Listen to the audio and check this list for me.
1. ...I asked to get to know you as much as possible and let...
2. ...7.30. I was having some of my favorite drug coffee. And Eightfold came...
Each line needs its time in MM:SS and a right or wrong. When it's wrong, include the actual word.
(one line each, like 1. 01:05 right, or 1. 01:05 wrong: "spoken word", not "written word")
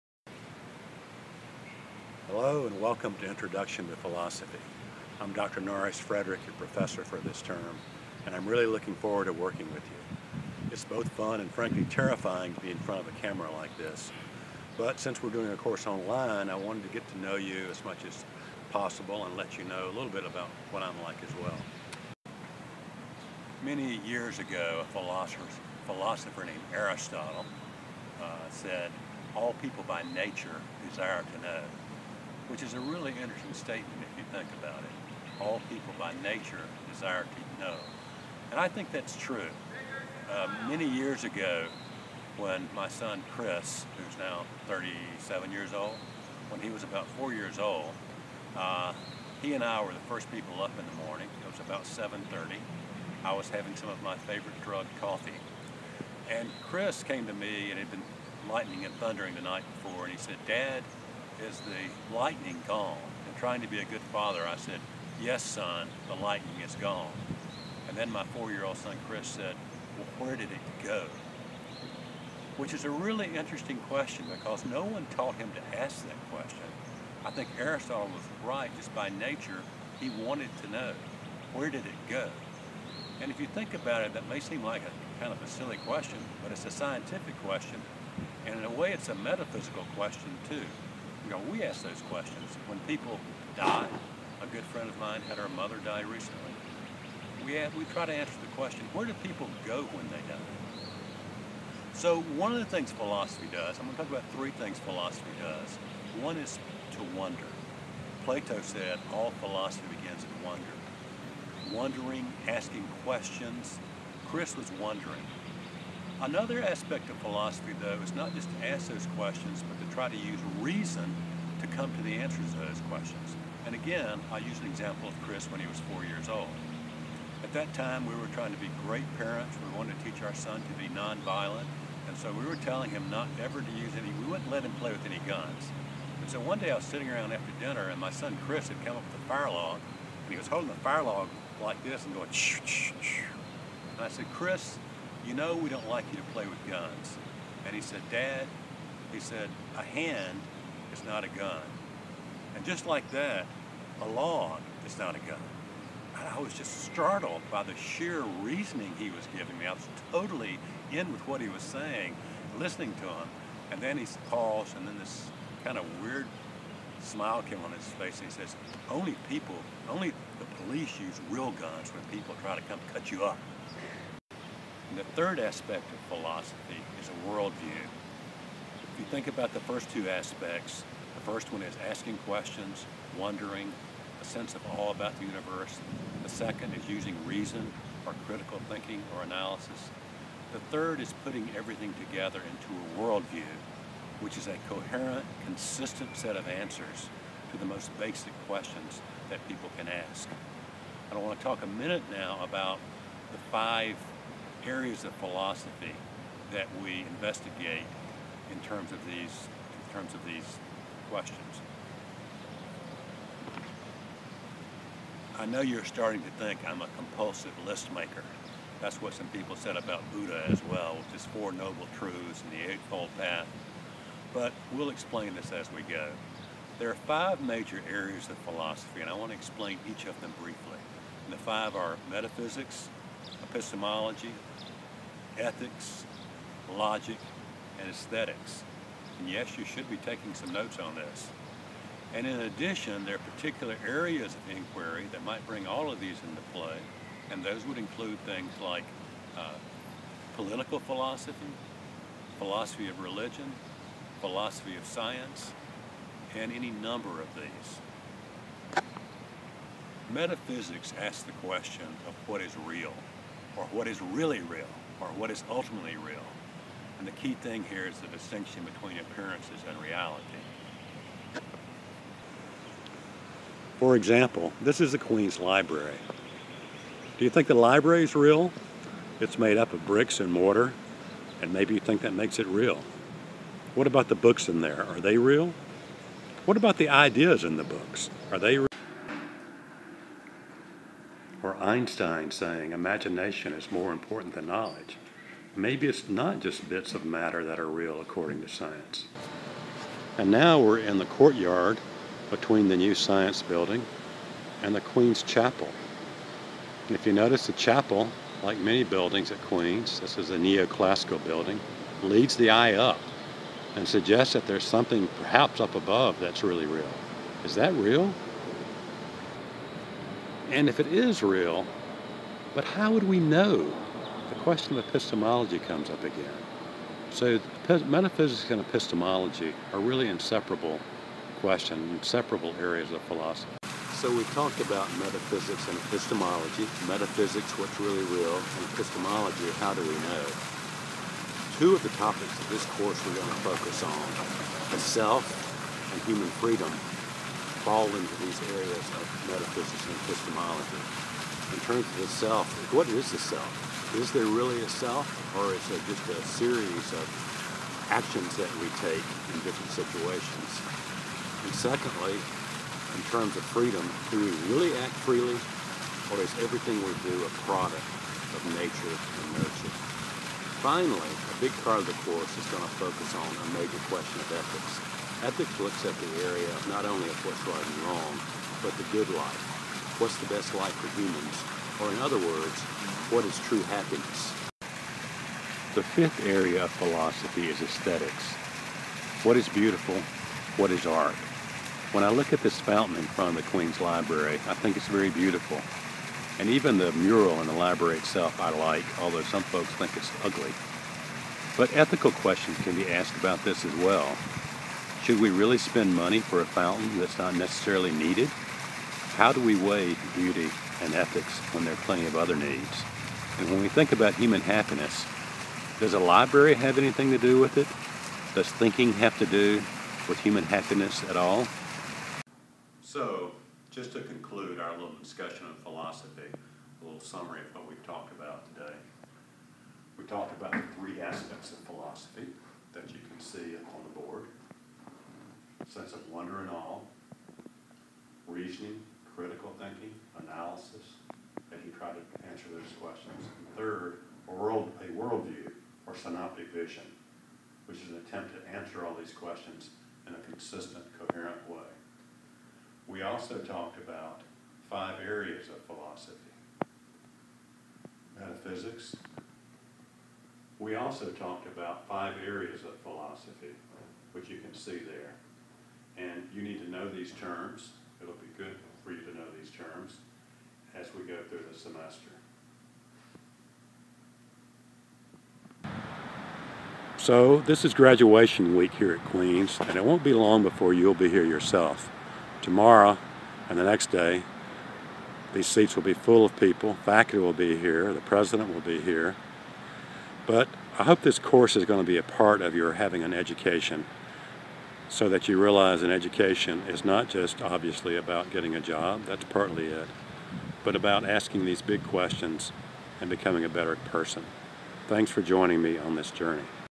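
1. 00:16 wrong: "wanted", not "asked"
2. 00:51 wrong: "Chris", not "Eightfold".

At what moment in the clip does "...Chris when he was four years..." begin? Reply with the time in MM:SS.
02:05.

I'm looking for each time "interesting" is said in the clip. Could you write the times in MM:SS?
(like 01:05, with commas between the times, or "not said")
00:33, 01:13.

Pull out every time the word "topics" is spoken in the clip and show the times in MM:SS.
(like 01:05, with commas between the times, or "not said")
05:41.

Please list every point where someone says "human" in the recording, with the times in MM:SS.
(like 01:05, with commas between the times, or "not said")
05:46, 06:20, 06:54, 07:00.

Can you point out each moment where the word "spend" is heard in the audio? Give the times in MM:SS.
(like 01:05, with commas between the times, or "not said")
06:45.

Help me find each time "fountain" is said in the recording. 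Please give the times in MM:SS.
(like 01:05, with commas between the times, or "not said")
06:32, 06:46.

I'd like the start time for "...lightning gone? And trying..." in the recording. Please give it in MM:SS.
01:02.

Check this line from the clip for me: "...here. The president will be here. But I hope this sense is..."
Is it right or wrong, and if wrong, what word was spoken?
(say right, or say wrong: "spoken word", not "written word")
wrong: "course", not "sense".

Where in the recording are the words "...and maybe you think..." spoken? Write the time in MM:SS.
04:41.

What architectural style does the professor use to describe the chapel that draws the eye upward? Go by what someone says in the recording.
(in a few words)
neoclassical.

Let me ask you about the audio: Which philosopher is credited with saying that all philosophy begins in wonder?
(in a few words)
Plato.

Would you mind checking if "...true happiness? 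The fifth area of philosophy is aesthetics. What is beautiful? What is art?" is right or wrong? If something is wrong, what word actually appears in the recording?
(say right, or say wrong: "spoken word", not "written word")
right.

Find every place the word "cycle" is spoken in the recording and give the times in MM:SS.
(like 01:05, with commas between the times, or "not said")
not said.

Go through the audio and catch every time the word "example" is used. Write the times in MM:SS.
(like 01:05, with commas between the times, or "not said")
02:04, 04:33.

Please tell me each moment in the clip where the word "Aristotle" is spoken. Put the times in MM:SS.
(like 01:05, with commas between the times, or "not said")
00:26, 01:17.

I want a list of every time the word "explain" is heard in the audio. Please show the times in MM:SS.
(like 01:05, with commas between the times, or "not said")
03:44, 03:49.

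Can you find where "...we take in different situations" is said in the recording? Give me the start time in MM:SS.
05:58.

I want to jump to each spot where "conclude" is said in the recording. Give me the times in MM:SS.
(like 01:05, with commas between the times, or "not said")
07:04.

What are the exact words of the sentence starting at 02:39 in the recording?
I was totally in with what he was saying, listening to him.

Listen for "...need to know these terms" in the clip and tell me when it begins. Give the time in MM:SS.
07:46.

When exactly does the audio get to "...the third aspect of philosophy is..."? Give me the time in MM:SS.
02:54.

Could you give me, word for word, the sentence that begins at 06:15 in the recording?
Ethics looks at the area of not only of what's right and wrong, but the good life.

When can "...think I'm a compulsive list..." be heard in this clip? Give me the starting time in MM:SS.
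03:36.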